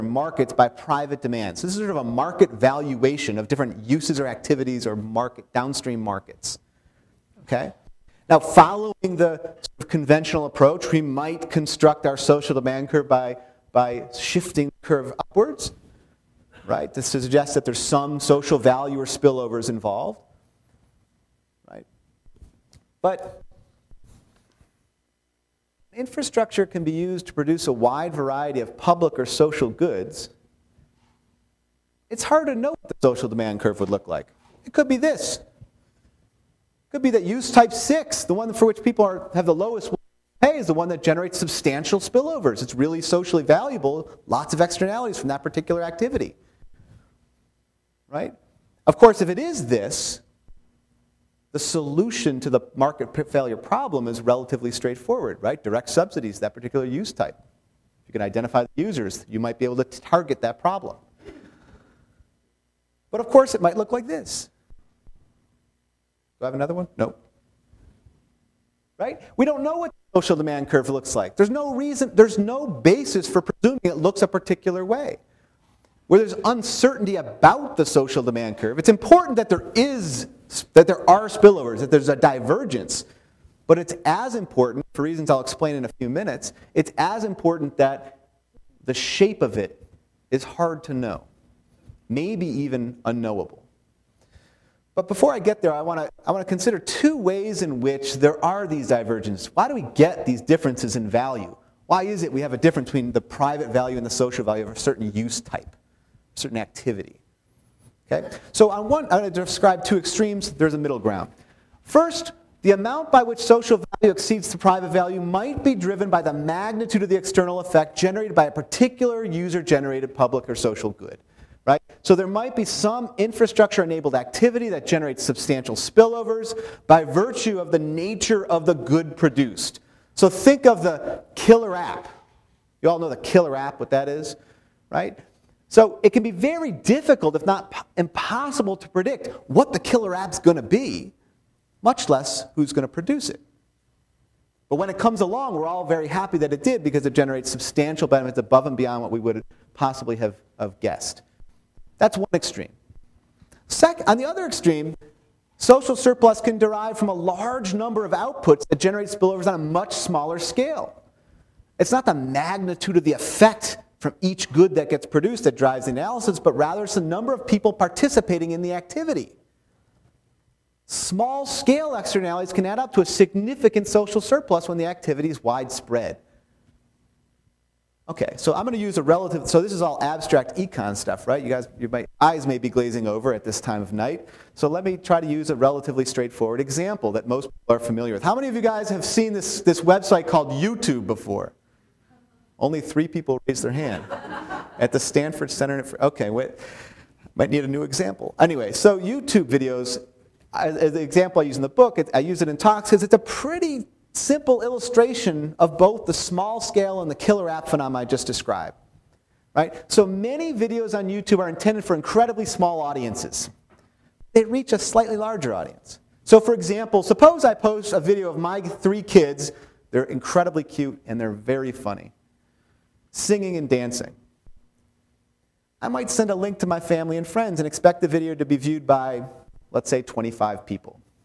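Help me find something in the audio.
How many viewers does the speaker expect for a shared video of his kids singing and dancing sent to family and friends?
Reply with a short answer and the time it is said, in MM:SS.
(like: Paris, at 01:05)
25, at 03:50.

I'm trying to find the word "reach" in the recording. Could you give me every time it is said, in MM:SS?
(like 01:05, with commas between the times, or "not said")
03:34.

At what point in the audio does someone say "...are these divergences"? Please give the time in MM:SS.
01:38.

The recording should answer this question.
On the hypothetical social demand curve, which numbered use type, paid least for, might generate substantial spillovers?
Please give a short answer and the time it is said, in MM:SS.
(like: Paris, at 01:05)
6, at 00:37.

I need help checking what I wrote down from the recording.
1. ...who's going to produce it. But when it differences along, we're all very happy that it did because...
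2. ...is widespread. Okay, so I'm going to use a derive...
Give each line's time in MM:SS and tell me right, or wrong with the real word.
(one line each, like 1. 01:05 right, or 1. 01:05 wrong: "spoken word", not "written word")
1. 02:22 wrong: "comes", not "differences"
2. 02:55 wrong: "relative", not "derive".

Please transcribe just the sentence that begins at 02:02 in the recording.
So there might be some infrastructure enabled activity that generates substantial spillovers by virtue of the nature of the good produced.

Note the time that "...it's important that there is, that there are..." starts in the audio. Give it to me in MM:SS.
01:18.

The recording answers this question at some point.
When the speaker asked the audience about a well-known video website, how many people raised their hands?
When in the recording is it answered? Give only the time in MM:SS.
03:12.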